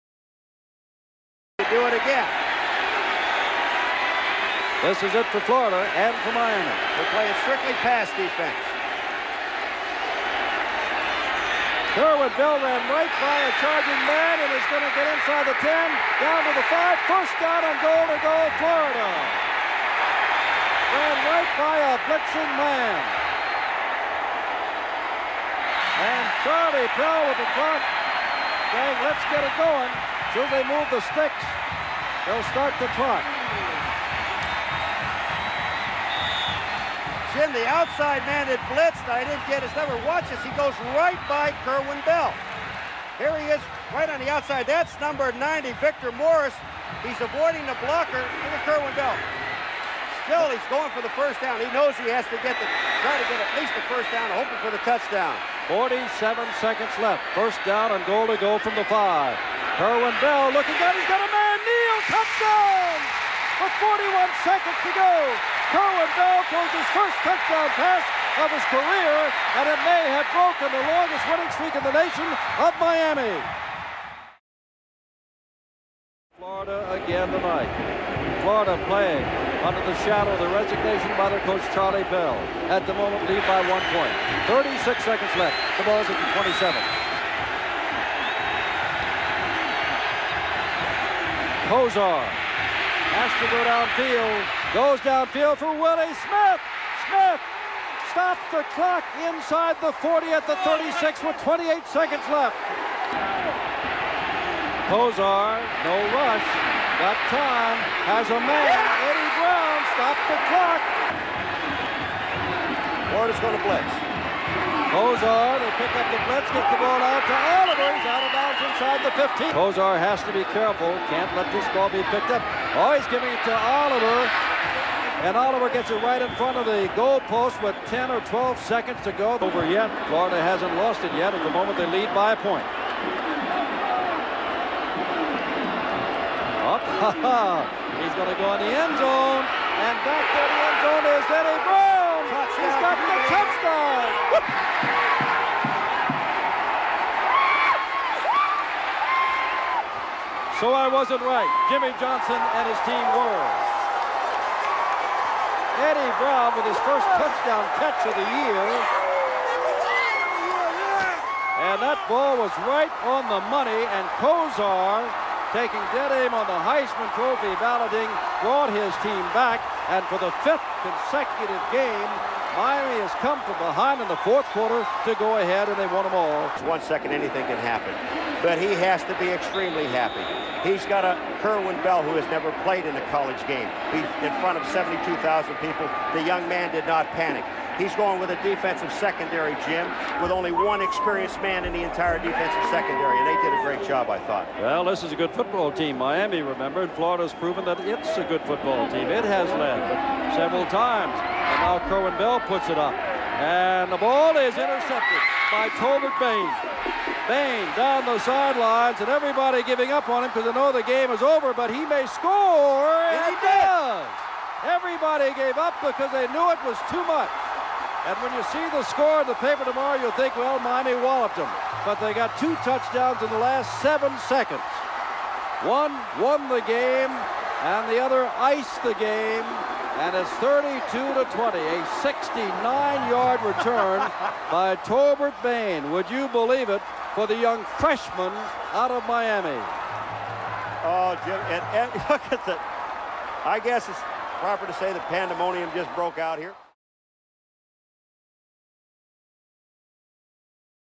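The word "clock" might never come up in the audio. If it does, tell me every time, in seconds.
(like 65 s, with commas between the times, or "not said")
27 s, 32 s, 98 s, 110 s.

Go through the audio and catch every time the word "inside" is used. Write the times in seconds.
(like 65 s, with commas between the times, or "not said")
15 s, 99 s.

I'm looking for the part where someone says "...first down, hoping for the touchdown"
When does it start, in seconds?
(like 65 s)
53 s.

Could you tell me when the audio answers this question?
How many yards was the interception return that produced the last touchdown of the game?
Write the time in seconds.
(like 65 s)
232 s.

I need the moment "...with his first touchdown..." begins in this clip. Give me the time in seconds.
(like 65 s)
156 s.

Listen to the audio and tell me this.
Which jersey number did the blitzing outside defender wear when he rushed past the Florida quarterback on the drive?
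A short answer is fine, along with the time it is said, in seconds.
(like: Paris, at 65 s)
90, at 45 s.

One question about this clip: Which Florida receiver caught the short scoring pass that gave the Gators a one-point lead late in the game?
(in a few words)
Neal.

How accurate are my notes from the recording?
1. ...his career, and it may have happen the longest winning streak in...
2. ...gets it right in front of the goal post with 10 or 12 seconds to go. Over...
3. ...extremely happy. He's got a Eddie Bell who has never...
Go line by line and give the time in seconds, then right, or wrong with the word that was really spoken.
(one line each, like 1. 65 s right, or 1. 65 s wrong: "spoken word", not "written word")
1. 68 s wrong: "broken", not "happen"
2. 125 s right
3. 179 s wrong: "Kerwin", not "Eddie".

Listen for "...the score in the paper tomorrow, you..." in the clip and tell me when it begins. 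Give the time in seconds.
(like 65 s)
218 s.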